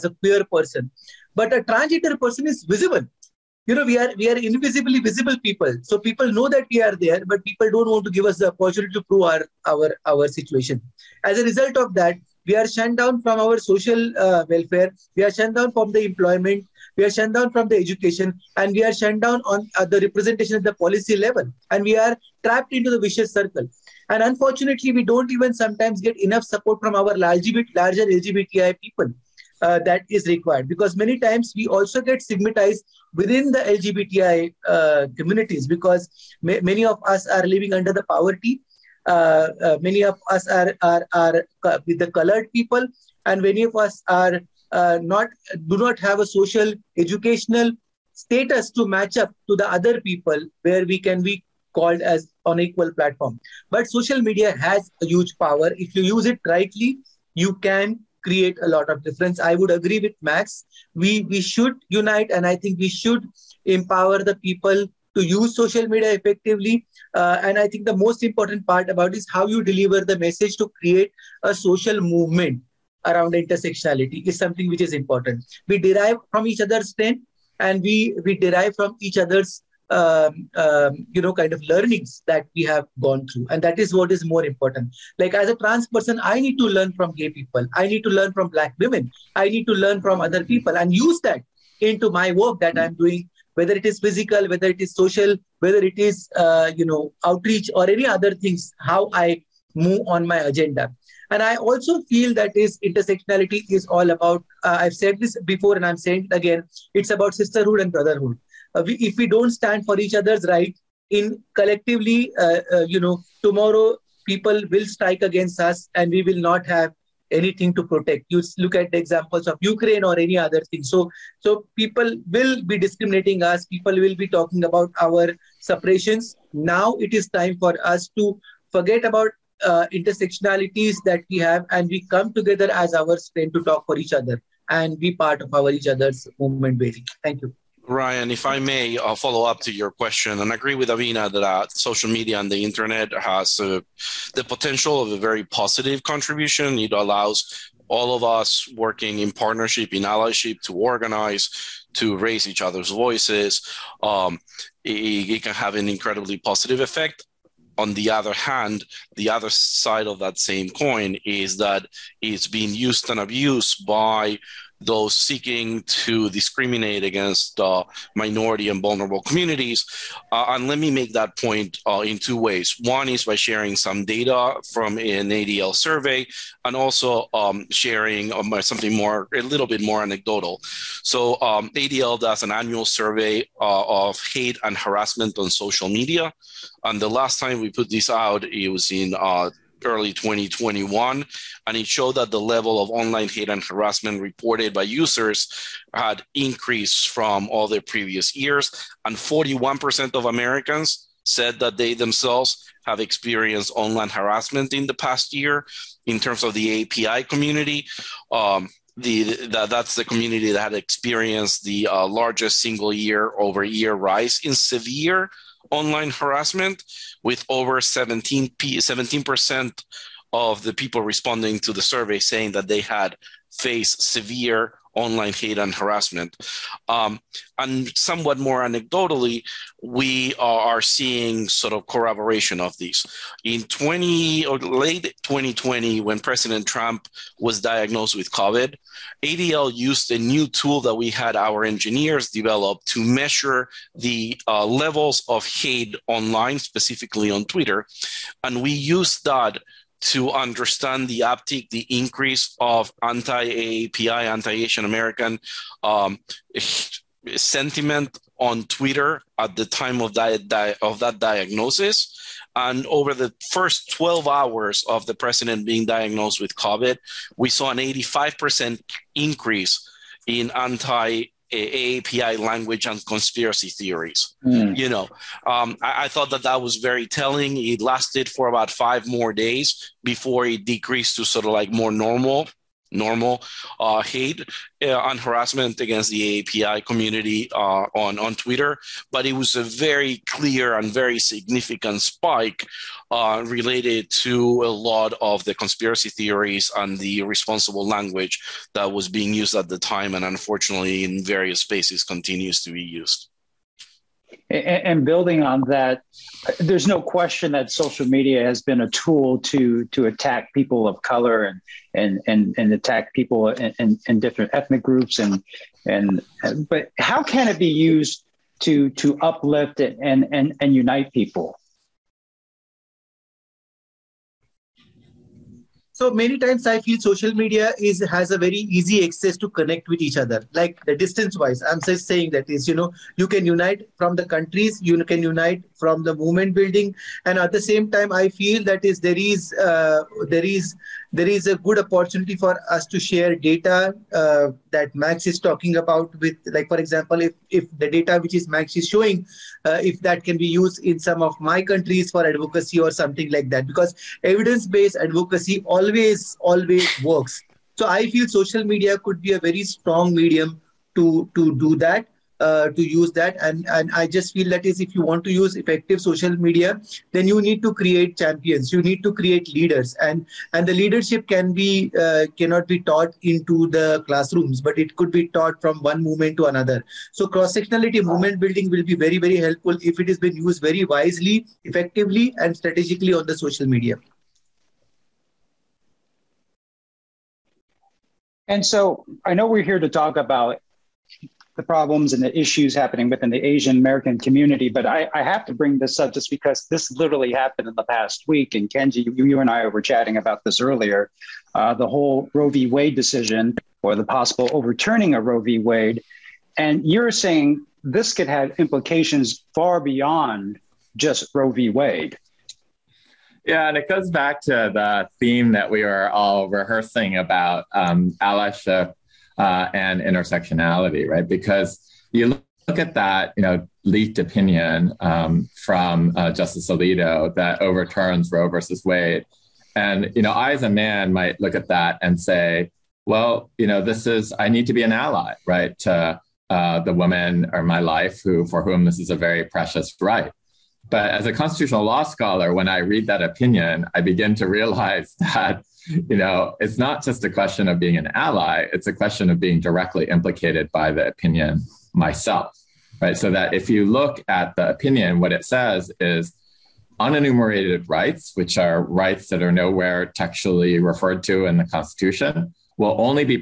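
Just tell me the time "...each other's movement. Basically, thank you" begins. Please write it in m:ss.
2:15.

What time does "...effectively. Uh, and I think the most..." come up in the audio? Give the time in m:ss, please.
1:06.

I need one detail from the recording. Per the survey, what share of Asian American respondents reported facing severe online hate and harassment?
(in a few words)
over 17%.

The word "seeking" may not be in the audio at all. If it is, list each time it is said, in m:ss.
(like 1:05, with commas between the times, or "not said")
2:45.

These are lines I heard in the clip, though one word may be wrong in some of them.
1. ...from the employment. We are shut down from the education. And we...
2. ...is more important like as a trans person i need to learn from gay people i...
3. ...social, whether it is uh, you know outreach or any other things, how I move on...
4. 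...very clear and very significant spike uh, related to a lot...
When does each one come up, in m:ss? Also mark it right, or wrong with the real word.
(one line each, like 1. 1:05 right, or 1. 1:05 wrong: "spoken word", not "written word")
1. 0:15 right
2. 1:24 right
3. 1:34 right
4. 4:49 right.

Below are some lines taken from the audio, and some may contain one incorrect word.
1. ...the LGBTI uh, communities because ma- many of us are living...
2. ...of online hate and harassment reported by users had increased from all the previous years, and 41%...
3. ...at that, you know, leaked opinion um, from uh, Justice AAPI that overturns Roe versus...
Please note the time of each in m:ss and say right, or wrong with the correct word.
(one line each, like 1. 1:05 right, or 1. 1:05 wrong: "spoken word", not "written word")
1. 0:33 right
2. 3:12 right
3. 7:02 wrong: "Alito", not "AAPI".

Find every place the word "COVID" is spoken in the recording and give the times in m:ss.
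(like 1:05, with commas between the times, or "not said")
3:58, 4:26.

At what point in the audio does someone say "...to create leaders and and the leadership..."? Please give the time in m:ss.
6:09.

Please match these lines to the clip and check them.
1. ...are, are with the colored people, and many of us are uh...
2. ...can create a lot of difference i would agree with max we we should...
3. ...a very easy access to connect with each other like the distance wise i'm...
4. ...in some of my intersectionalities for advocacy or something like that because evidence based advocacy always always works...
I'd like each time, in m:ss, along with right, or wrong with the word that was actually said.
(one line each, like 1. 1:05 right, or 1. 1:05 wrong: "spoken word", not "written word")
1. 0:40 right
2. 0:57 right
3. 5:28 right
4. 5:50 wrong: "countries", not "intersectionalities".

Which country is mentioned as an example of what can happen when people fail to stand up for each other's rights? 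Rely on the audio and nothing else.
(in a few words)
Ukraine.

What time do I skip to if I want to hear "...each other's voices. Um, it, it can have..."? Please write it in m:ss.
2:32.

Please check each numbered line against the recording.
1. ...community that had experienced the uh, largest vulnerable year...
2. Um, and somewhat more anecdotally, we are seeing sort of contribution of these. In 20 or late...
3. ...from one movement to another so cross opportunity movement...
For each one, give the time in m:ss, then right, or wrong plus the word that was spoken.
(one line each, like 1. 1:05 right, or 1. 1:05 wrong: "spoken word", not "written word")
1. 3:30 wrong: "single", not "vulnerable"
2. 3:46 wrong: "corroboration", not "contribution"
3. 6:15 wrong: "sectionality", not "opportunity".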